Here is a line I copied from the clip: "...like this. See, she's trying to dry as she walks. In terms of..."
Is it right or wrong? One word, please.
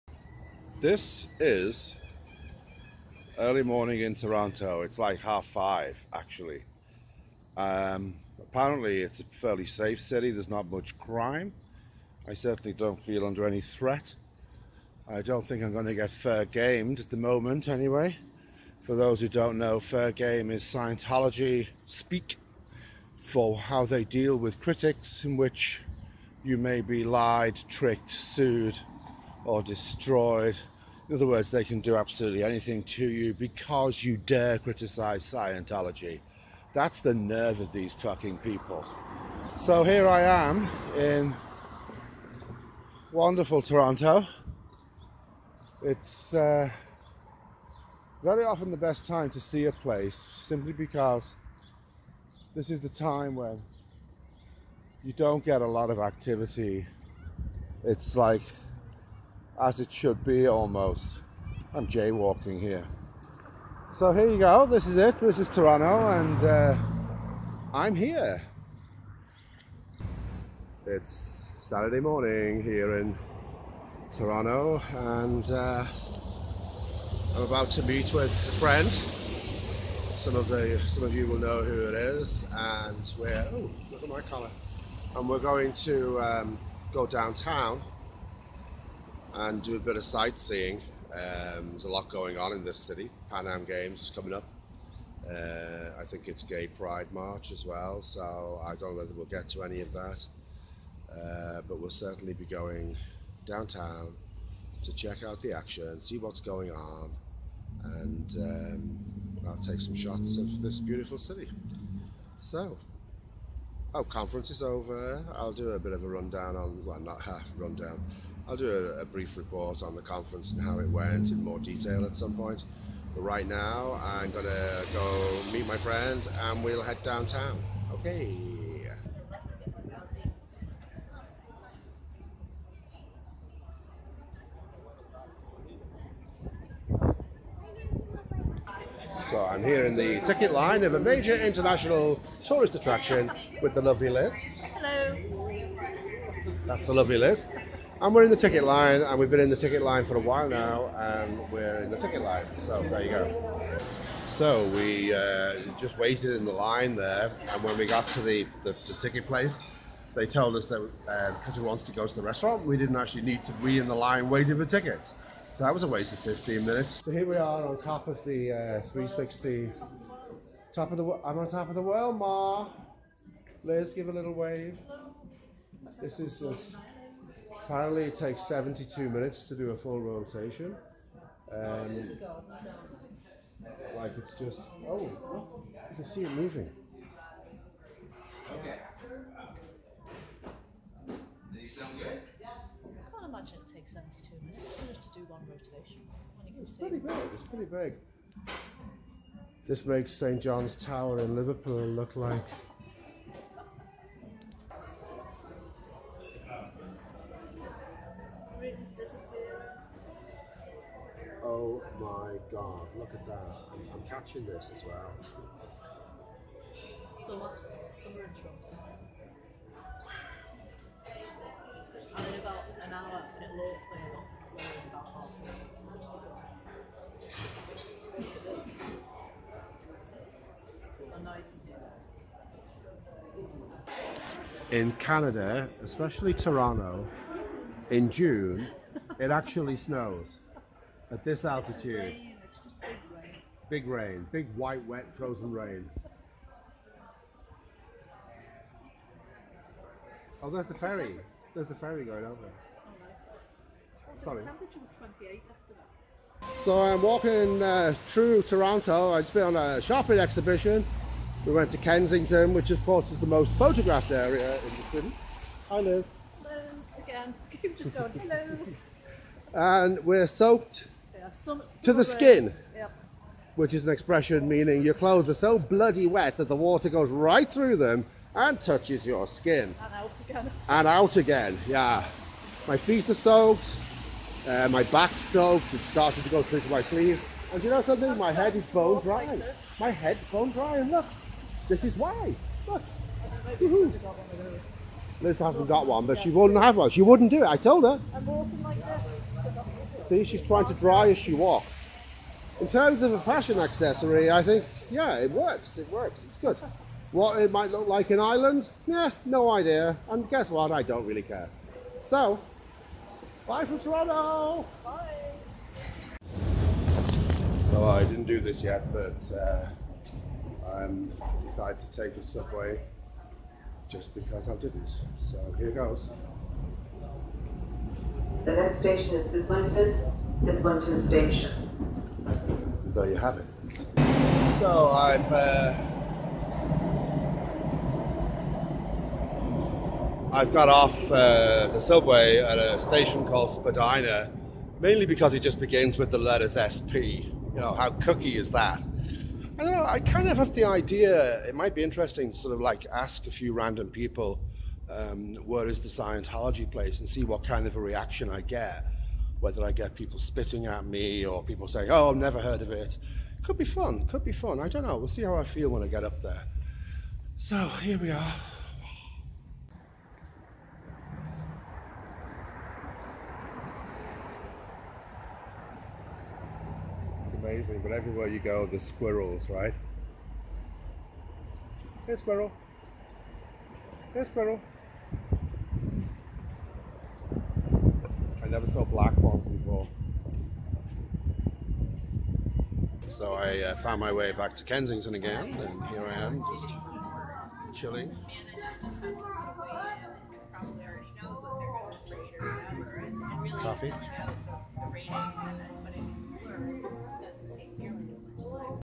right.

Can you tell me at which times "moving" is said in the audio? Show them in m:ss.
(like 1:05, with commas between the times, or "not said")
3:06.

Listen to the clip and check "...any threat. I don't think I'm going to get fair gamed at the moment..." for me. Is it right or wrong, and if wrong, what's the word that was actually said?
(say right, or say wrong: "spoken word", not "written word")
right.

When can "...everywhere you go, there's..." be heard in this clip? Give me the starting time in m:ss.
6:17.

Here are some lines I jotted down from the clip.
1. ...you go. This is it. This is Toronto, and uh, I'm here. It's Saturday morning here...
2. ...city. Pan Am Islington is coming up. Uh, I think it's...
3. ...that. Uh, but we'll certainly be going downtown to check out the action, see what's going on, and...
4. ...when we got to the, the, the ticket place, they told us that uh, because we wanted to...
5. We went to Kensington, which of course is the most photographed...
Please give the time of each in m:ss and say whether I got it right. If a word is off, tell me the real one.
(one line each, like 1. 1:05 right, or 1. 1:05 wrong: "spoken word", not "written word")
1. 1:04 right
2. 1:32 wrong: "Games", not "Islington"
3. 1:39 right
4. 2:37 right
5. 4:21 right.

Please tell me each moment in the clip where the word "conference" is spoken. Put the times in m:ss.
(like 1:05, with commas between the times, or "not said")
1:54, 2:00.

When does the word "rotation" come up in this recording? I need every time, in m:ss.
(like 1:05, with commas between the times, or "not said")
3:00, 3:15.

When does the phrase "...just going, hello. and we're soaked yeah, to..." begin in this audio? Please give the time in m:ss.
4:27.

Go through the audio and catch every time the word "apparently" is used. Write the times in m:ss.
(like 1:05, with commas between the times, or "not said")
0:08, 2:57.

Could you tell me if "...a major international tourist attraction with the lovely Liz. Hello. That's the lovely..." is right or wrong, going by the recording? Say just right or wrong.
right.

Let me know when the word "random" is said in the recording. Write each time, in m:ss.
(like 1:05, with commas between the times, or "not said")
5:53.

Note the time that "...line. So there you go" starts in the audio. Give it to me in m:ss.
2:32.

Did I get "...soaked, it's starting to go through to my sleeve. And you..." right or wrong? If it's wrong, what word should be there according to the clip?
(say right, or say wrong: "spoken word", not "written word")
right.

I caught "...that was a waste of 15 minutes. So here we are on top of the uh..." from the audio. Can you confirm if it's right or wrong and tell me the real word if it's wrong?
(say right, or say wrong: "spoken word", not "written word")
right.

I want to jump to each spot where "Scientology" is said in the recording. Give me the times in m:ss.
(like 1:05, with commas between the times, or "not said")
0:20, 0:35, 5:55.